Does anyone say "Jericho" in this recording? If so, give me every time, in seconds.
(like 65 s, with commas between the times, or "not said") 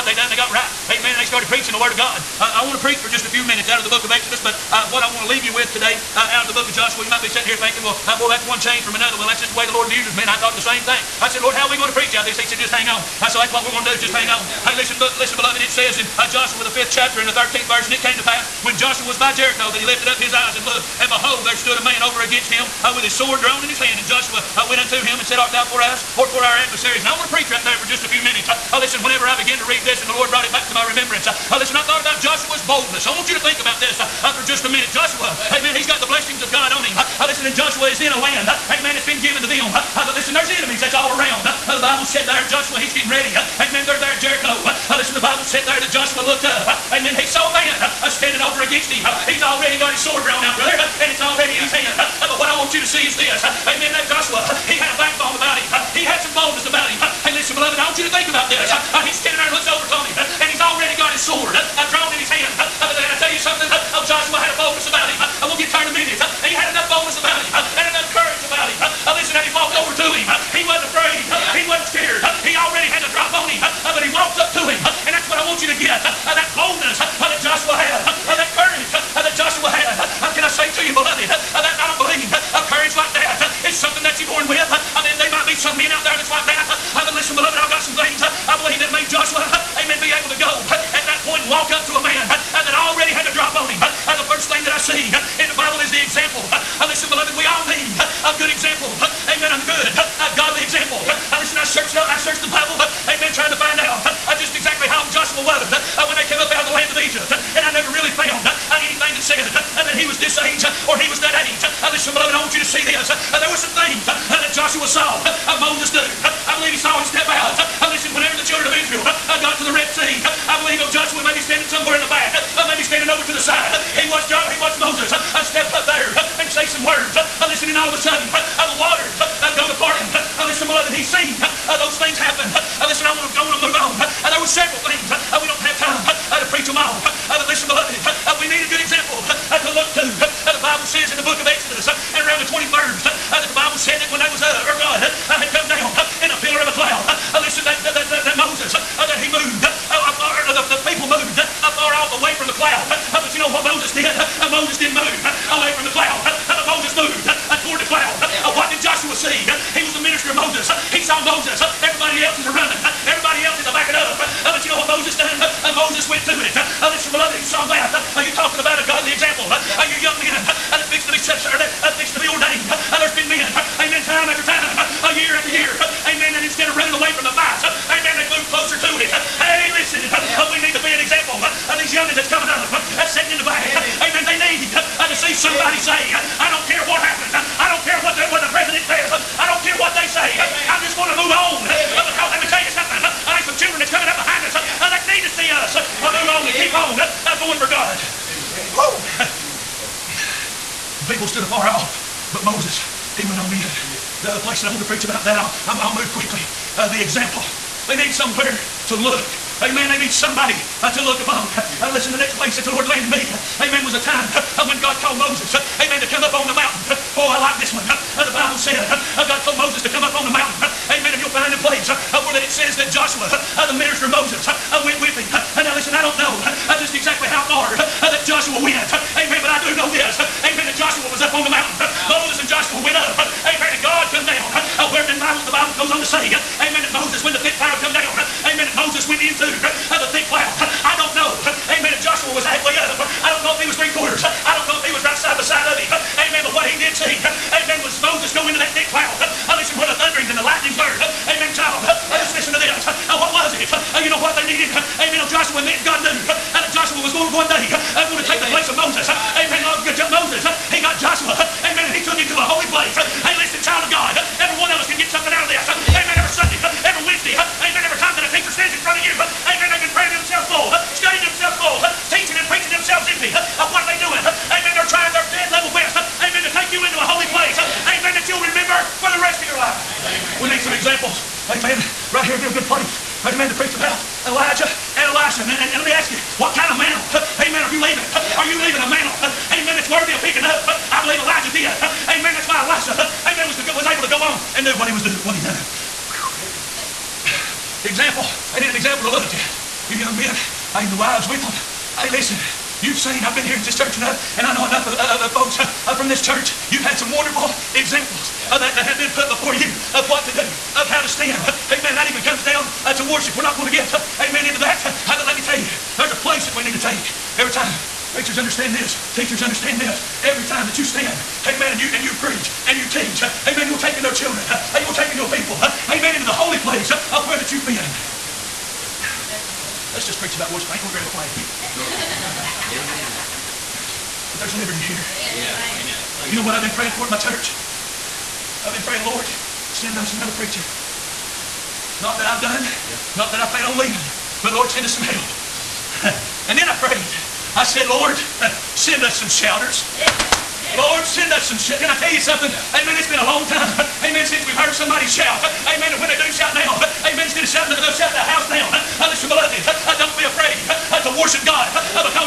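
19 s, 44 s.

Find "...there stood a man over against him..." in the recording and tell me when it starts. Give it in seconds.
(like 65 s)
21 s.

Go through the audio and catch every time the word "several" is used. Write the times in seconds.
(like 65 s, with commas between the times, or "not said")
134 s.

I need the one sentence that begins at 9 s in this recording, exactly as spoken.
Well, that's just the way the Lord uses me.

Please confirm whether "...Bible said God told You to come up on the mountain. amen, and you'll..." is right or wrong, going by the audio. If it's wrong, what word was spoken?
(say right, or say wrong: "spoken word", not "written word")
wrong: "Moses", not "You".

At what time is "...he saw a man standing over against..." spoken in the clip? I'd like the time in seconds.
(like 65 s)
47 s.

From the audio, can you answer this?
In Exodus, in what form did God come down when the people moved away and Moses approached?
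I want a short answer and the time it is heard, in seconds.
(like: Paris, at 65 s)
A pillar of a cloud, at 146 s.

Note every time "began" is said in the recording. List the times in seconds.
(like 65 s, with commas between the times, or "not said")
29 s.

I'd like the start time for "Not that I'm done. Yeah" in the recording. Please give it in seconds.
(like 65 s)
342 s.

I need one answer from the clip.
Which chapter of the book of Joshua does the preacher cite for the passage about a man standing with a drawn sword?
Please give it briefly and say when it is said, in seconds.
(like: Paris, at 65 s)
5th chapter, at 16 s.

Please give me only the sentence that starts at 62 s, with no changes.
and I tell you something, oh, Joshua had a boldness about him.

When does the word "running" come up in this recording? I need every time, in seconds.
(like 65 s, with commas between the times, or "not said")
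162 s, 176 s.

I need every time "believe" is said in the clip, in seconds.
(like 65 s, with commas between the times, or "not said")
81 s, 88 s, 116 s, 120 s, 291 s.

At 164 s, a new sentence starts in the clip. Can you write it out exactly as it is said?
Uh, but you know what Moses done?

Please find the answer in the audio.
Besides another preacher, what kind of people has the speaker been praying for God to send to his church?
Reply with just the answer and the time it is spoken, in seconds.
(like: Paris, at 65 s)
Shouters, at 349 s.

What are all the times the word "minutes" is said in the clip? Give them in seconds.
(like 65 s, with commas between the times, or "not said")
3 s, 28 s, 34 s, 65 s.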